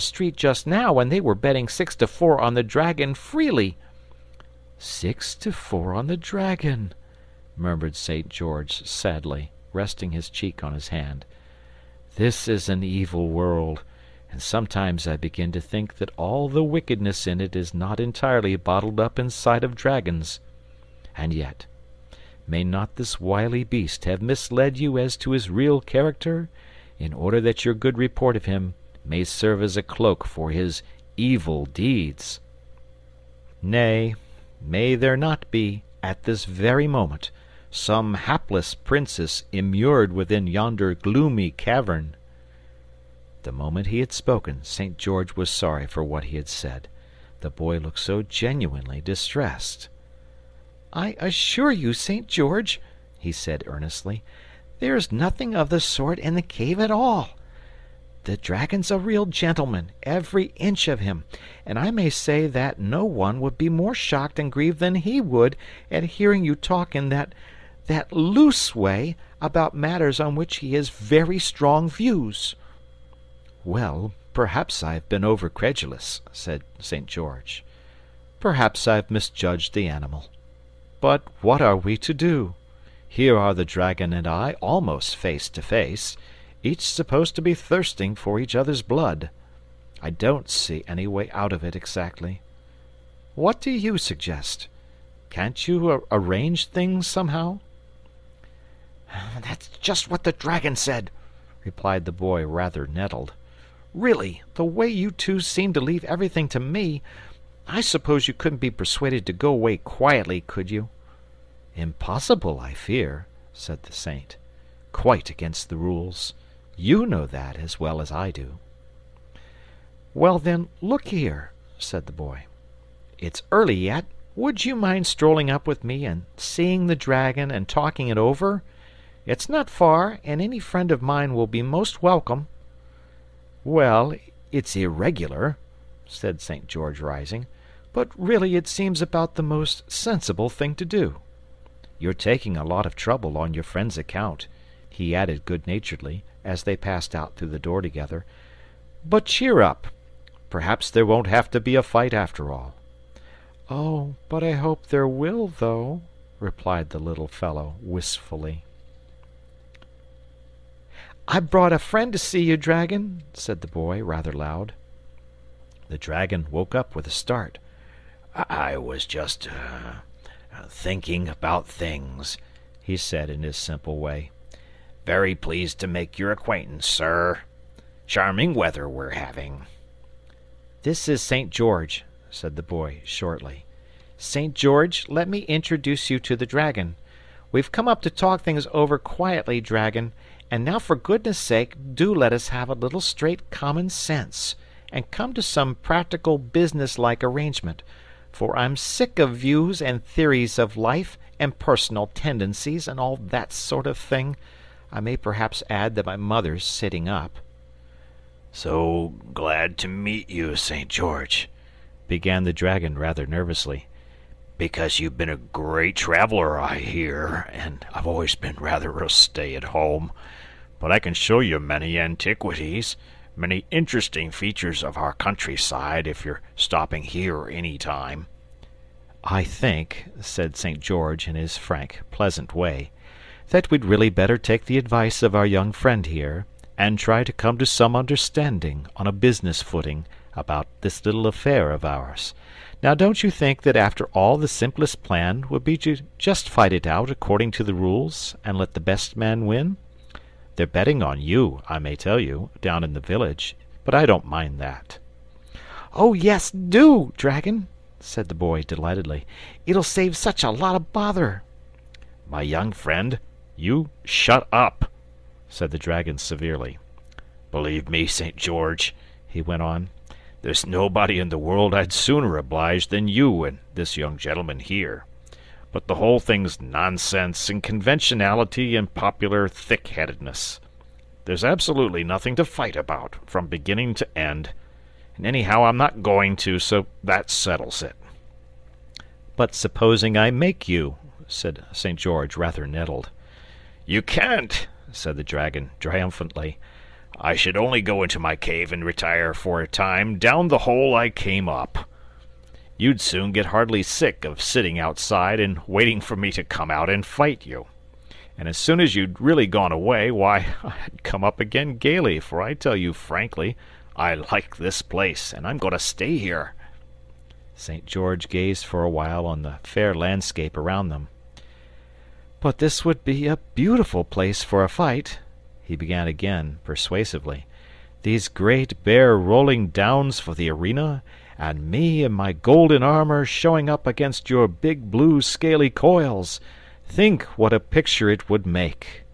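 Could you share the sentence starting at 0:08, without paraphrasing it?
George sadly, resting his cheek on his hand.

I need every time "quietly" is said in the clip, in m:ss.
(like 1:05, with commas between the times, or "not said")
1:49, 3:08.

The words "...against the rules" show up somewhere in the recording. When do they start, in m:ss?
1:55.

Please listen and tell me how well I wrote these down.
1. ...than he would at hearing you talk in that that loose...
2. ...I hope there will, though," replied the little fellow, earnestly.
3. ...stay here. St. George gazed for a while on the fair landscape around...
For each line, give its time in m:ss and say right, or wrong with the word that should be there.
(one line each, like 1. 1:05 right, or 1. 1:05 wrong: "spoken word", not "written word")
1. 1:04 right
2. 2:34 wrong: "wistfully", not "earnestly"
3. 5:15 right.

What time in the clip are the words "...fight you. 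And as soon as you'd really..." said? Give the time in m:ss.
5:07.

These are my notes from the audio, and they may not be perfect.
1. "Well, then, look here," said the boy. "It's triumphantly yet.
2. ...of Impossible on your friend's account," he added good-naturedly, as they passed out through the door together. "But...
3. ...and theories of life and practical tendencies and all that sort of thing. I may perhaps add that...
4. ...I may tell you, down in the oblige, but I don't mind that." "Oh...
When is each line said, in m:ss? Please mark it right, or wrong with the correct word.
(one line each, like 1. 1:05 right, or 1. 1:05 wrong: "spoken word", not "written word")
1. 2:00 wrong: "early", not "triumphantly"
2. 2:22 wrong: "trouble", not "Impossible"
3. 3:19 wrong: "personal", not "practical"
4. 4:11 wrong: "village", not "oblige".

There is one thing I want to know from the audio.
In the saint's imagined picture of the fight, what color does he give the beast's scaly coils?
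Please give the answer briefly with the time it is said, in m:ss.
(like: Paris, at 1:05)
Blue, at 5:34.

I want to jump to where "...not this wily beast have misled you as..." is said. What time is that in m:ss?
0:22.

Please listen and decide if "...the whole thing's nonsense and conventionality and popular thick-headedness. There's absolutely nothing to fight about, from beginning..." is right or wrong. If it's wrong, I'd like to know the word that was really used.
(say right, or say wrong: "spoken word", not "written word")
right.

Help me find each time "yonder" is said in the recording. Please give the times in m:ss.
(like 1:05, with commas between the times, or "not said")
0:40.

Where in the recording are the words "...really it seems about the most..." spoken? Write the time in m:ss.
2:18.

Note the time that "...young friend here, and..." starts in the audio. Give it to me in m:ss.
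3:55.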